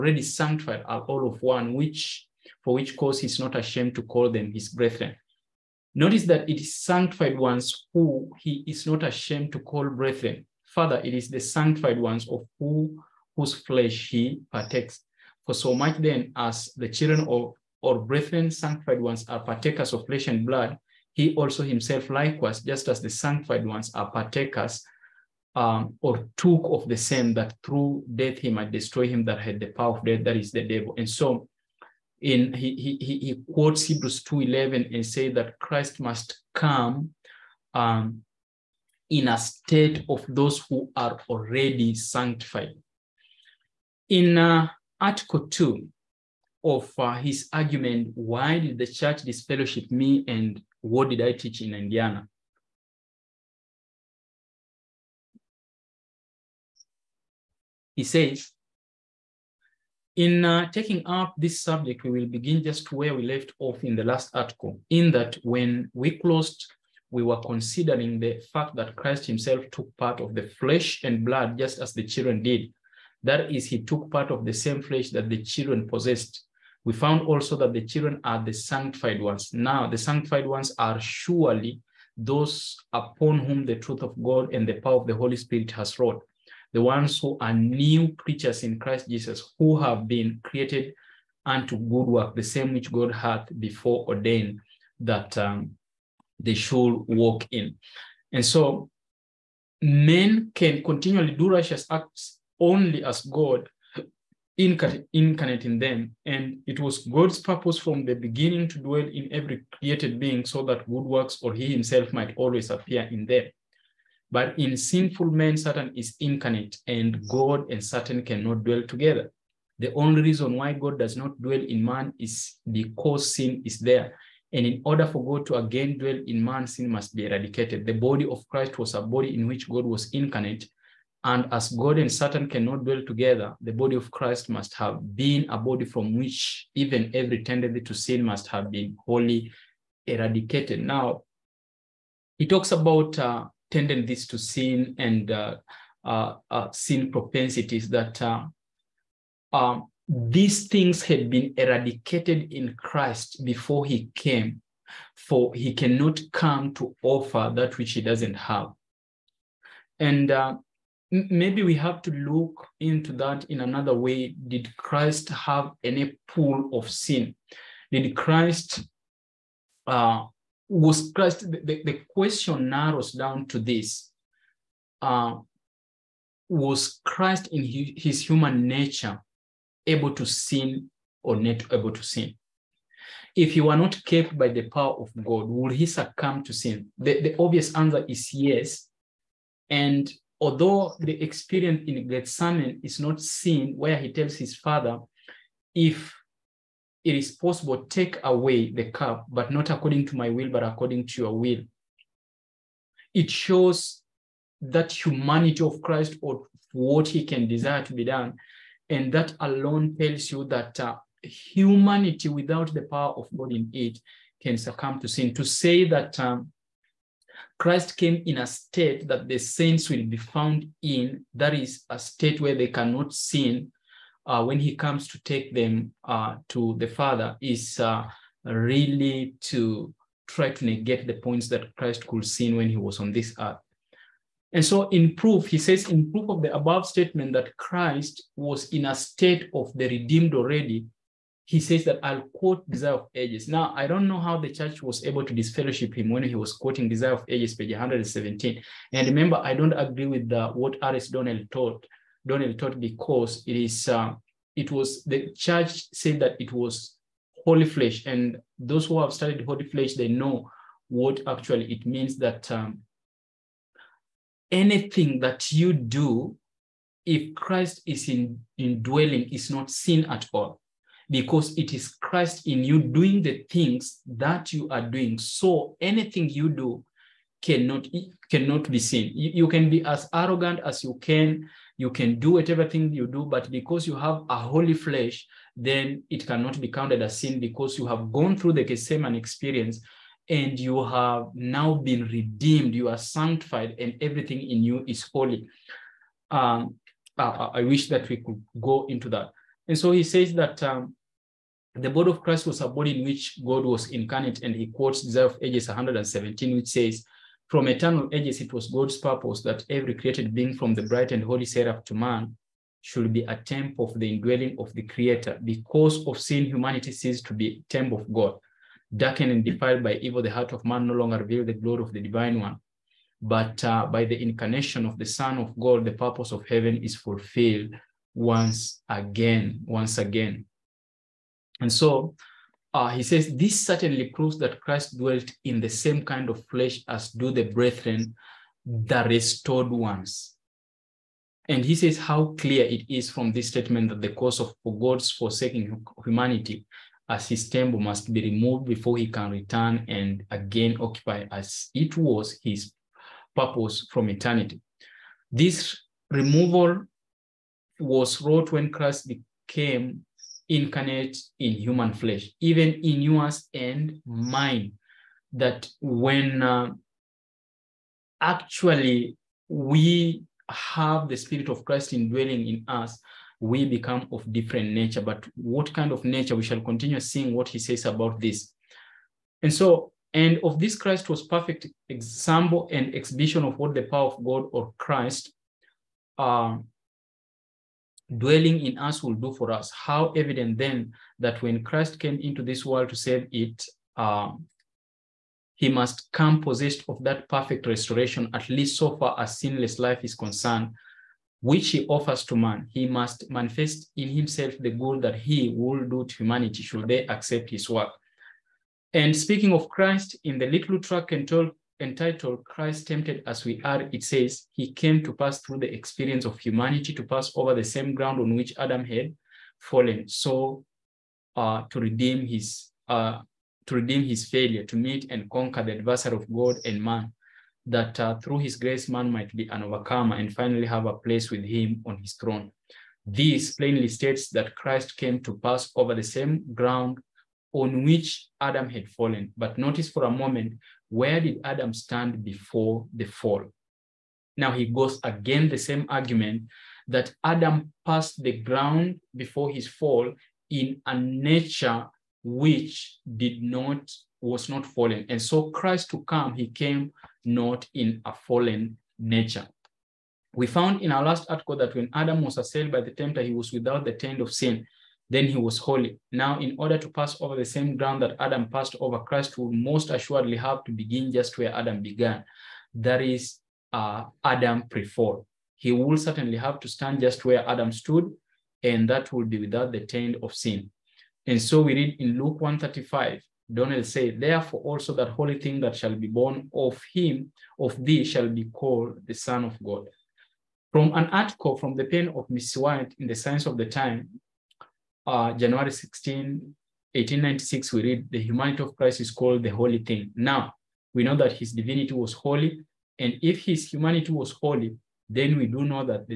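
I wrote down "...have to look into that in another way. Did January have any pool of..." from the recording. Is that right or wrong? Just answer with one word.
wrong.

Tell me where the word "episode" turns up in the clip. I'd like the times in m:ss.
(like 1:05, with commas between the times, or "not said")
not said.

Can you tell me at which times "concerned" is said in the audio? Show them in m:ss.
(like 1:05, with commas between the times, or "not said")
6:40.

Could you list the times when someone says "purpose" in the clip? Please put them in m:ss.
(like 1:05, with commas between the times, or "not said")
1:47, 5:08, 5:25, 5:53.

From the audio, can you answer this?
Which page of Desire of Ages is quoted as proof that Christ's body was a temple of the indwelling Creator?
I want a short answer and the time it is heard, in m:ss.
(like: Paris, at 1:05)
117, at 4:07.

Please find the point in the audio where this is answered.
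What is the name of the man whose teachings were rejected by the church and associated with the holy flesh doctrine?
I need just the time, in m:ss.
4:10.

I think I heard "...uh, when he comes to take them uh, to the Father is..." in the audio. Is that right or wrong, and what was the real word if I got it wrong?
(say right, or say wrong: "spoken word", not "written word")
right.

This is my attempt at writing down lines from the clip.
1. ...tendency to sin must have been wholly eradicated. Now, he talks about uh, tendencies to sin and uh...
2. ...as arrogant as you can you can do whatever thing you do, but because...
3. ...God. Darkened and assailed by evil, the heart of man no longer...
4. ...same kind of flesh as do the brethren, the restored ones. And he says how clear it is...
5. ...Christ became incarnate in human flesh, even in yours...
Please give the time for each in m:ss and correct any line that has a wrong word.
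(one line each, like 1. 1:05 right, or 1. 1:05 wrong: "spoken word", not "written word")
1. 2:17 right
2. 4:39 right
3. 5:18 wrong: "defiled", not "assailed"
4. 5:35 right
5. 5:58 right.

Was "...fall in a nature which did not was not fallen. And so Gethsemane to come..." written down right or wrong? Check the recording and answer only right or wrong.
wrong.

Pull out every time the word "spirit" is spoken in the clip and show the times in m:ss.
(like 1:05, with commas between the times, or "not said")
1:25, 6:11.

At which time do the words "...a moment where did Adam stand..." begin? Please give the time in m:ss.
7:20.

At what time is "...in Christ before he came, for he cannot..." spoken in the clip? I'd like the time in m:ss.
2:32.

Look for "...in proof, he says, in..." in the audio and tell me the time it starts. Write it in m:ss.
3:54.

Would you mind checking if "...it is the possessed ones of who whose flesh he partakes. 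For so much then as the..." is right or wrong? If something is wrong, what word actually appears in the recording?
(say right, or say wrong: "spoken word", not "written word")
wrong: "sanctified", not "possessed".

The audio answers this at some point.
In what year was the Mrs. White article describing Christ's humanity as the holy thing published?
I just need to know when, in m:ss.
8:16.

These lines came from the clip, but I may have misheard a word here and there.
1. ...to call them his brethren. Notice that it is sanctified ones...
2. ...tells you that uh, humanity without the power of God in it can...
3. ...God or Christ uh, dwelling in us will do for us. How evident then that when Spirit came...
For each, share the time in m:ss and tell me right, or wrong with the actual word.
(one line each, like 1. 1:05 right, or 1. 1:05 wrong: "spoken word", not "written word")
1. 0:03 right
2. 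3:29 right
3. 6:24 wrong: "Christ", not "Spirit".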